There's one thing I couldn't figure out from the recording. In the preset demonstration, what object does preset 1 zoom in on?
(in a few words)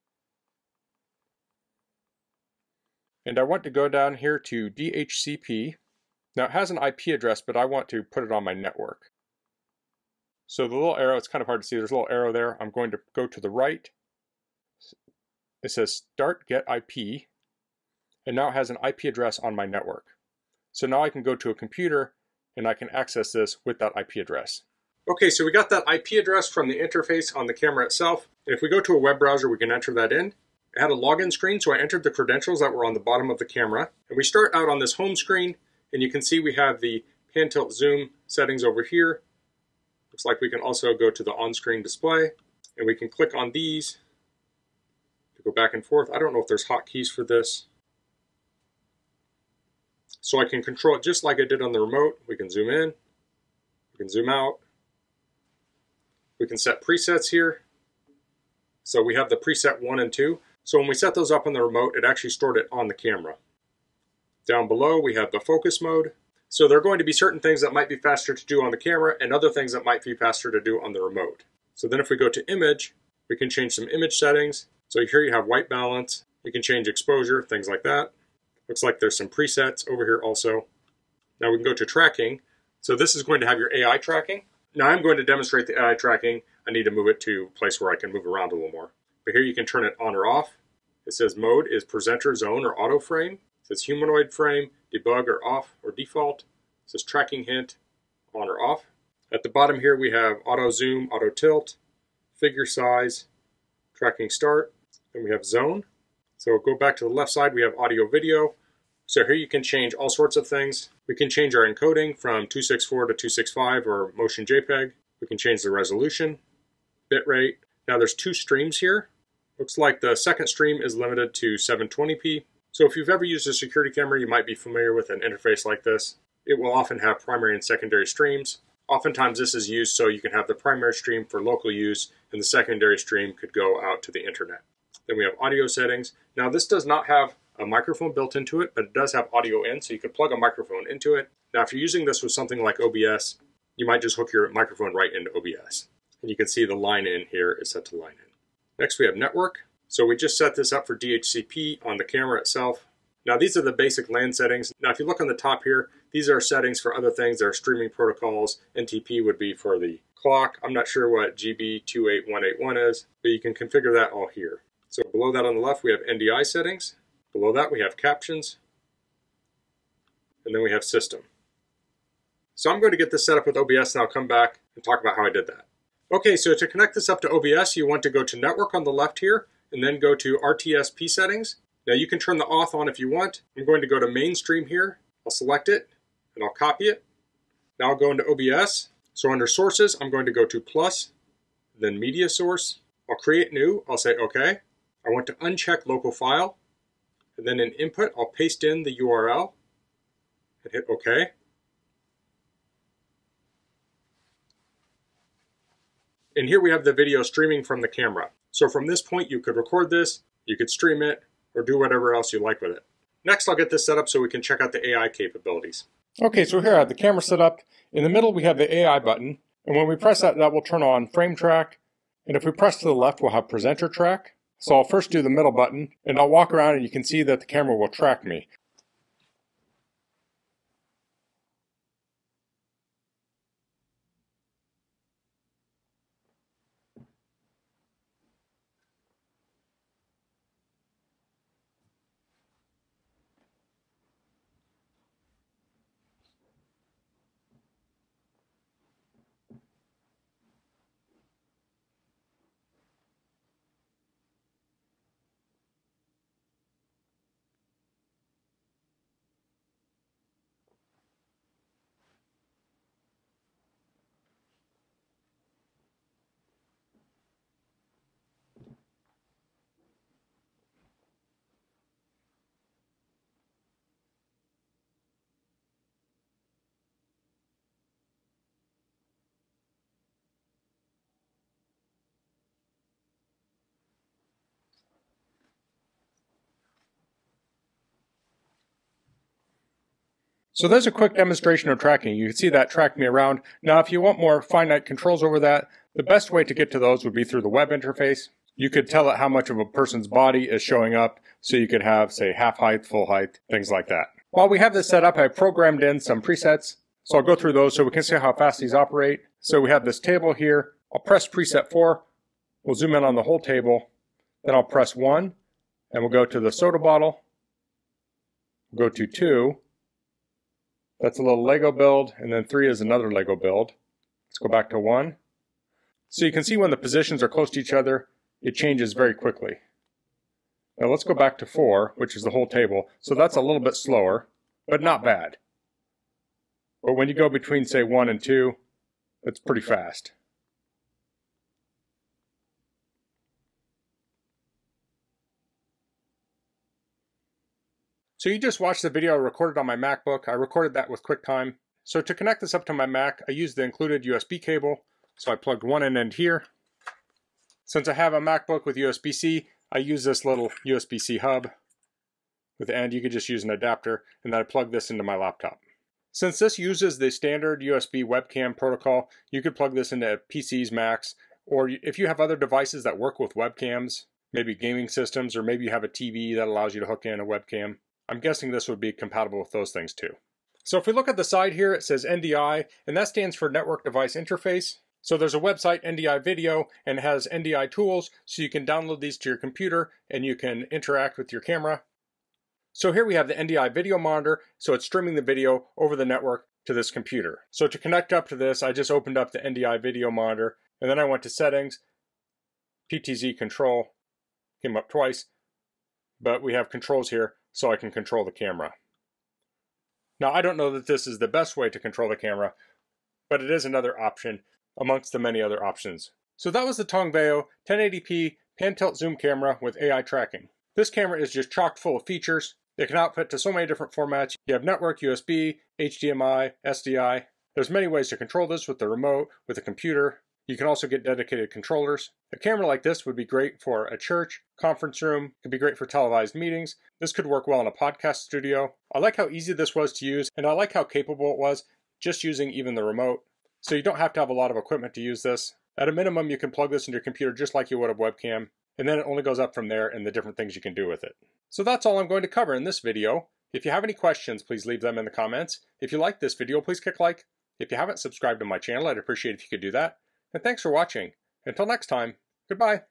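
Soda bottle.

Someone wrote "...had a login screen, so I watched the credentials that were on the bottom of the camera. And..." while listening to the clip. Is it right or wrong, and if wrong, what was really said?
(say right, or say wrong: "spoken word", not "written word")
wrong: "entered", not "watched".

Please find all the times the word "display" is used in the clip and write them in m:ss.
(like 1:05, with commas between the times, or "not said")
0:41.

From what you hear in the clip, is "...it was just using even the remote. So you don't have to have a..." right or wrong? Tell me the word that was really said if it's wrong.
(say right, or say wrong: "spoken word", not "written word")
right.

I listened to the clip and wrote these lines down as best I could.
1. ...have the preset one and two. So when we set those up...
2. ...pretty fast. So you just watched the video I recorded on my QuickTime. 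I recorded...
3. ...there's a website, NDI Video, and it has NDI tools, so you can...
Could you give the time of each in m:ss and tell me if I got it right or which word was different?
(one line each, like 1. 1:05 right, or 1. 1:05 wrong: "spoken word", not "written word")
1. 0:59 right
2. 5:39 wrong: "MacBook", not "QuickTime"
3. 6:25 right.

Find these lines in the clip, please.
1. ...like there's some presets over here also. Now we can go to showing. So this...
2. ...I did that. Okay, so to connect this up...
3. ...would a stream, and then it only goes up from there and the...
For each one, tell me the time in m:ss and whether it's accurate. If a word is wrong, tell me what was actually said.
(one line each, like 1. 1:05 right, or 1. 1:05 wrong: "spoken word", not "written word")
1. 1:18 wrong: "tracking", not "showing"
2. 2:55 right
3. 7:27 wrong: "webcam", not "stream".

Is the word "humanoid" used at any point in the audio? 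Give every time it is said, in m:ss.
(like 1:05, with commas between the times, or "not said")
1:33.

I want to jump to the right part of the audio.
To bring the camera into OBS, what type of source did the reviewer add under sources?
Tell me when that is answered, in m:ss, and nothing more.
3:11.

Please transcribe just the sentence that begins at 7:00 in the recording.
This camera is just chock full of features.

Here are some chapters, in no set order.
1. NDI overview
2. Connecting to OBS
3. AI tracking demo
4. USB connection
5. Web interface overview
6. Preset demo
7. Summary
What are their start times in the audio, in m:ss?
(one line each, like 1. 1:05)
1. 6:20
2. 2:52
3. 3:32
4. 5:47
5. 0:24
6. 5:03
7. 6:56.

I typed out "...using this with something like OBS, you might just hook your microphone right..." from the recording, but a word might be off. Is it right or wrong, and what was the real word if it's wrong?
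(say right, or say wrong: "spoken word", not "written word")
right.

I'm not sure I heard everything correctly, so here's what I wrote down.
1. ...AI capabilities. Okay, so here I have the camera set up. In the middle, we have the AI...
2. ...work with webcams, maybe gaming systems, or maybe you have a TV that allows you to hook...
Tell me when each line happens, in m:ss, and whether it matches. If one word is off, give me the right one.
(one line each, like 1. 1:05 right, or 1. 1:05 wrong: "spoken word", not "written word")
1. 3:34 right
2. 6:12 right.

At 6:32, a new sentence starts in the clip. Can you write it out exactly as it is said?
So here we have the NDI video monitor, so it's streaming the video over the network to this computer.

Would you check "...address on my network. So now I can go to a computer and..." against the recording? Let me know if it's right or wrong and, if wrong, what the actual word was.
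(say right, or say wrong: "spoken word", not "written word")
right.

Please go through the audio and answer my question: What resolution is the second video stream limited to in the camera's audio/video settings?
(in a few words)
720p.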